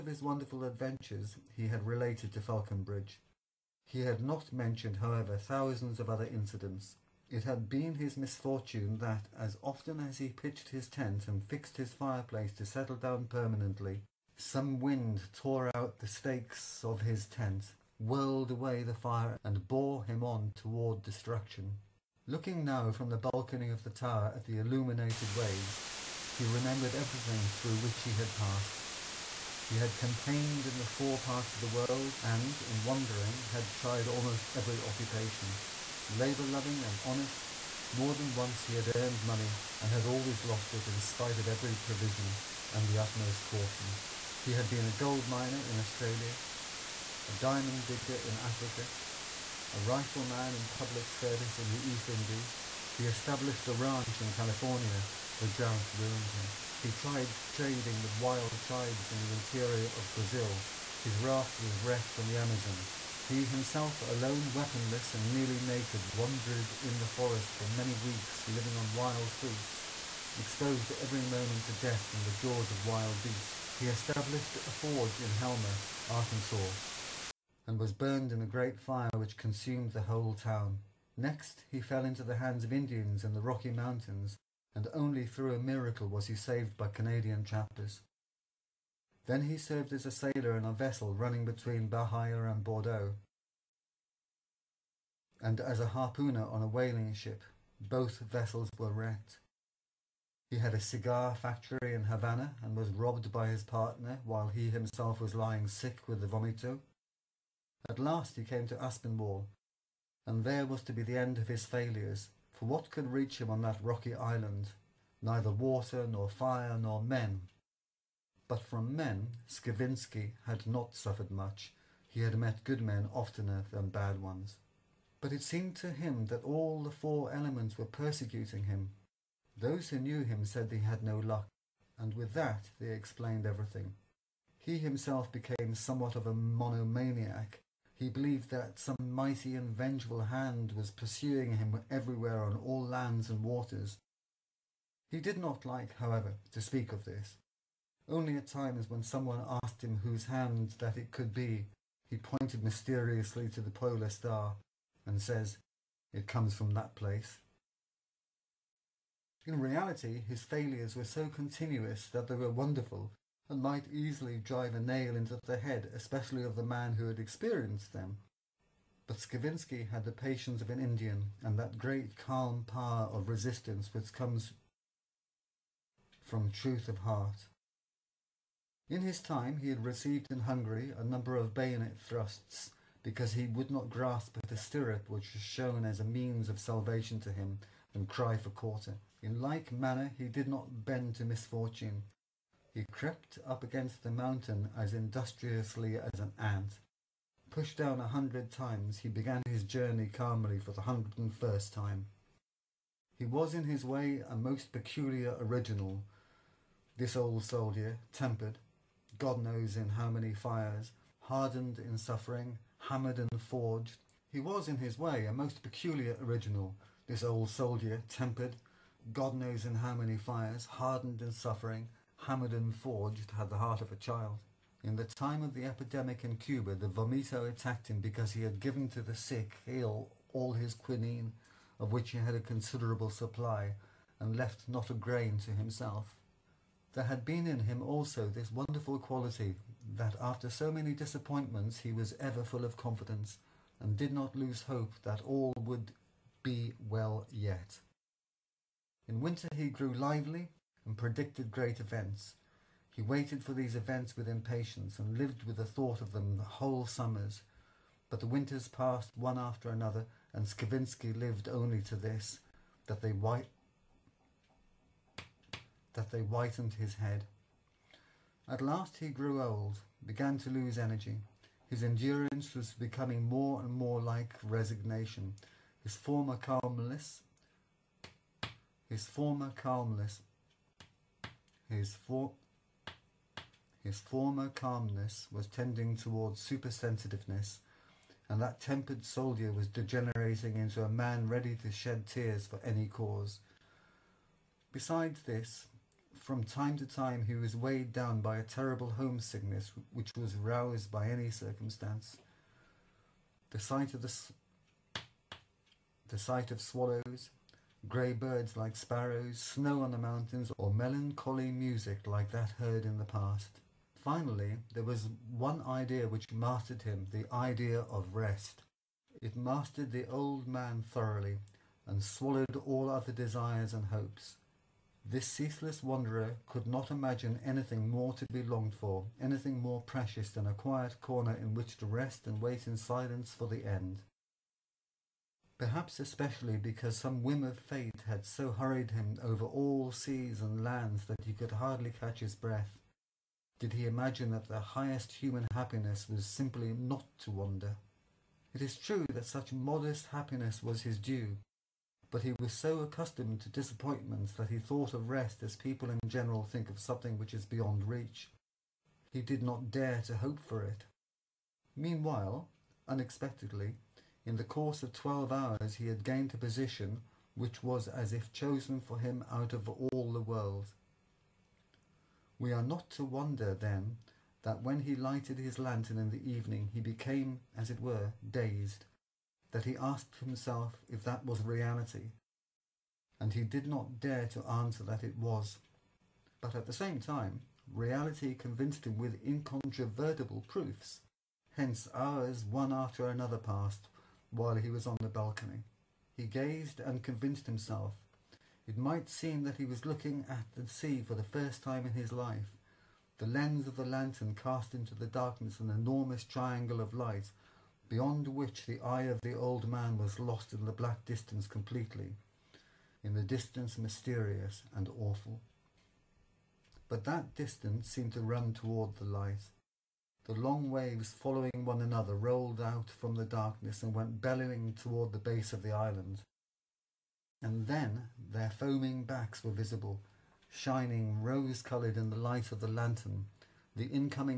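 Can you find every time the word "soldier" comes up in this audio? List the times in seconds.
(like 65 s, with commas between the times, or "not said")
207 s, 217 s, 289 s.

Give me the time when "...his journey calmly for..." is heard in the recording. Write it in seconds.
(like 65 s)
199 s.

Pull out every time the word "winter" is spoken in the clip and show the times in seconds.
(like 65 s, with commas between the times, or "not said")
249 s, 258 s.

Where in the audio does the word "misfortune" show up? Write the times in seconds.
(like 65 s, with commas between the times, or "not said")
8 s, 191 s.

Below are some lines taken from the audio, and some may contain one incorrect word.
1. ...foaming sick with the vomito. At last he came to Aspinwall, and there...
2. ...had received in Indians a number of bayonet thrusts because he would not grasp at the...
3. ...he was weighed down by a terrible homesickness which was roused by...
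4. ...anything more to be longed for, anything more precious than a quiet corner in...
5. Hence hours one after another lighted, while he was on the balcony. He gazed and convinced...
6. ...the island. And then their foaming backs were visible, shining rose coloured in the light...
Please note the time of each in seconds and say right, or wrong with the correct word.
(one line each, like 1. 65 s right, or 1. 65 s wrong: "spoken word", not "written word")
1. 105 s wrong: "lying", not "foaming"
2. 179 s wrong: "Hungary", not "Indians"
3. 297 s right
4. 327 s right
5. 391 s wrong: "passed", not "lighted"
6. 425 s right.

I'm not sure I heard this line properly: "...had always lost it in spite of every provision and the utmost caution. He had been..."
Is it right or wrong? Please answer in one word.
right.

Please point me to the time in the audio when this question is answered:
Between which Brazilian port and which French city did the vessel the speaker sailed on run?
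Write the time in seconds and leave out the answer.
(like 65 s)
91 s.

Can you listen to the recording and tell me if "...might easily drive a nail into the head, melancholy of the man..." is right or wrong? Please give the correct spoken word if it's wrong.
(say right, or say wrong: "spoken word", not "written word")
wrong: "especially", not "melancholy".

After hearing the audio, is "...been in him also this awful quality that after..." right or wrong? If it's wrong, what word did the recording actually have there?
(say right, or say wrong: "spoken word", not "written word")
wrong: "wonderful", not "awful".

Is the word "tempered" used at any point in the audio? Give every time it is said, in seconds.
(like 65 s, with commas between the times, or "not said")
208 s, 218 s, 288 s.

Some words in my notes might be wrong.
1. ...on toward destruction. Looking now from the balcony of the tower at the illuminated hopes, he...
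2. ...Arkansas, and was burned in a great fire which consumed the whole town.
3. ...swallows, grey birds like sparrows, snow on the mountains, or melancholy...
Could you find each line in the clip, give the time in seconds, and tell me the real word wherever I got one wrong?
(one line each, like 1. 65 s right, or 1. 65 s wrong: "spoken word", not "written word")
1. 20 s wrong: "waves", not "hopes"
2. 76 s right
3. 306 s right.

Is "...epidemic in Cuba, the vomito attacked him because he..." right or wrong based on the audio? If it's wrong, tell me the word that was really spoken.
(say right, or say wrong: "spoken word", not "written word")
right.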